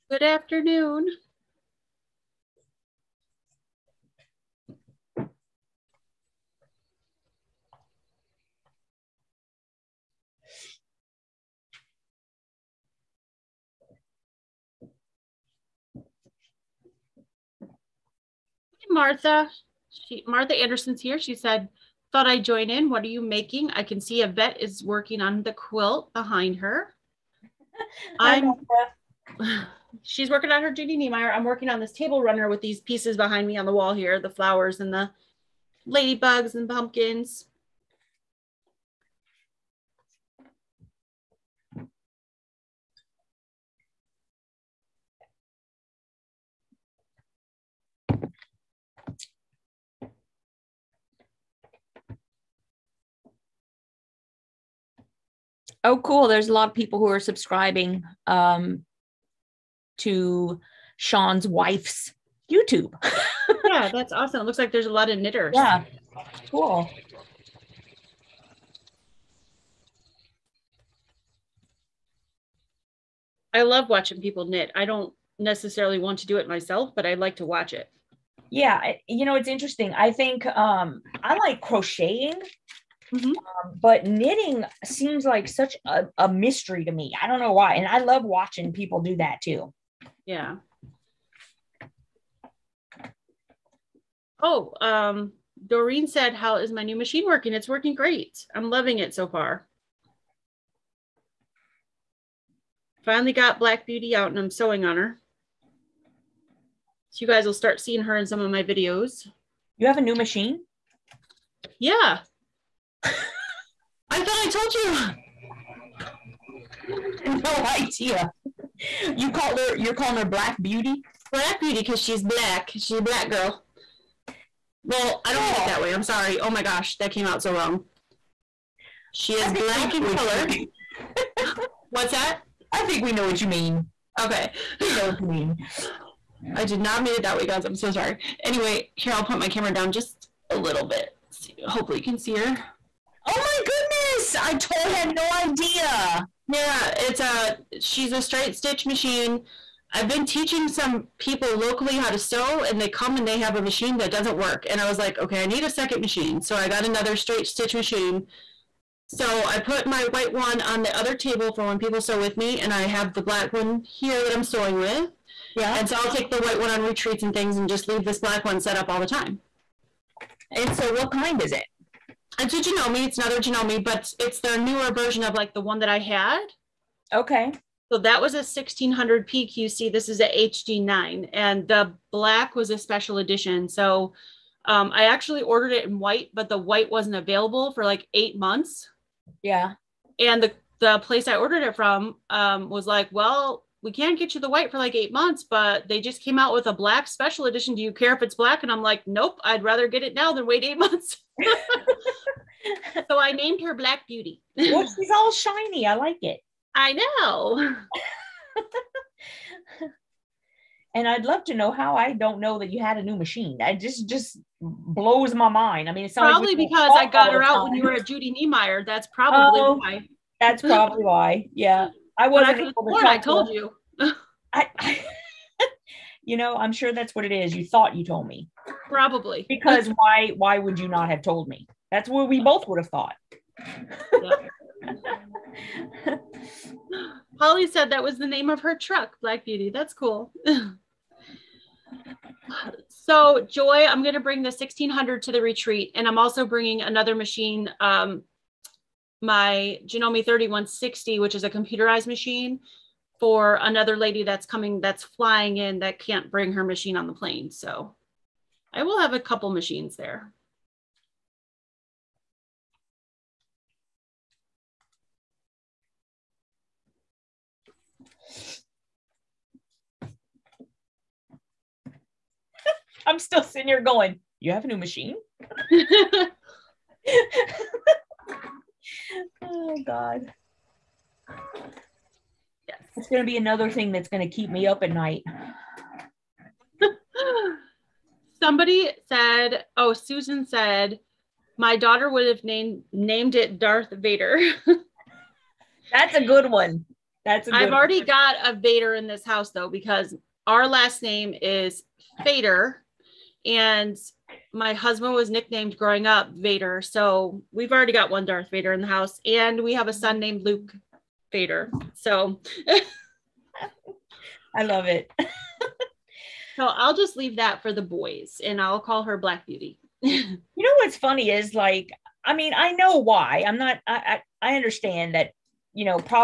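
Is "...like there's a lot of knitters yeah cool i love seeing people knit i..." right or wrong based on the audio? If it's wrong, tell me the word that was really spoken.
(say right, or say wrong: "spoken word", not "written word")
wrong: "watching", not "seeing".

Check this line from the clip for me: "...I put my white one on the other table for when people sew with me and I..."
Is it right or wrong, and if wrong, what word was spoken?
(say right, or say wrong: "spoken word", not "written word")
right.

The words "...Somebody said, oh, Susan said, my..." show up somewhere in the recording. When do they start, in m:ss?
4:48.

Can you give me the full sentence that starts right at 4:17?
So I will have a couple machines there.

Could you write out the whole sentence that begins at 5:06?
So we've already got one Darth Vader in the house, and we have a son named Luke Vader.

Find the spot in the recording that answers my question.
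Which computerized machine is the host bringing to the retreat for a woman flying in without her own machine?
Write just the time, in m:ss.
4:09.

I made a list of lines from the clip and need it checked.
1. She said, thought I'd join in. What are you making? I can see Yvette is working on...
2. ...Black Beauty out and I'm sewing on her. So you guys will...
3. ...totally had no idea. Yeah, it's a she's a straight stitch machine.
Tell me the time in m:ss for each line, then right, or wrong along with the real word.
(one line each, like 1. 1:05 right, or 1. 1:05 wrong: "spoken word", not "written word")
1. 0:21 right
2. 1:43 right
3. 2:24 right.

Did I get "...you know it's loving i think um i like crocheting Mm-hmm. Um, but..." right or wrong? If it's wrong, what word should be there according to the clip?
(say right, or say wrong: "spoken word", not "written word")
wrong: "interesting", not "loving".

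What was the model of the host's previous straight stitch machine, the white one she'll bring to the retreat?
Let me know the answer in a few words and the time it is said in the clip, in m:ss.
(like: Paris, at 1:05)
1600 PQC, at 2:58.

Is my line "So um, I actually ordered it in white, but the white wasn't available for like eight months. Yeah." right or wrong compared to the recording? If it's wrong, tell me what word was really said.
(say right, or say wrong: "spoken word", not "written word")
right.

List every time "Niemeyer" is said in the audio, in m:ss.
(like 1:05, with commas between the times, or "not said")
0:30, 3:38.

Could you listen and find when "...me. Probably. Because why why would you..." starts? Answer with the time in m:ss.
3:48.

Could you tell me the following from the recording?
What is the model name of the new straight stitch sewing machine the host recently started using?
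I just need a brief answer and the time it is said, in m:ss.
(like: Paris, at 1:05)
HD9, at 3:00.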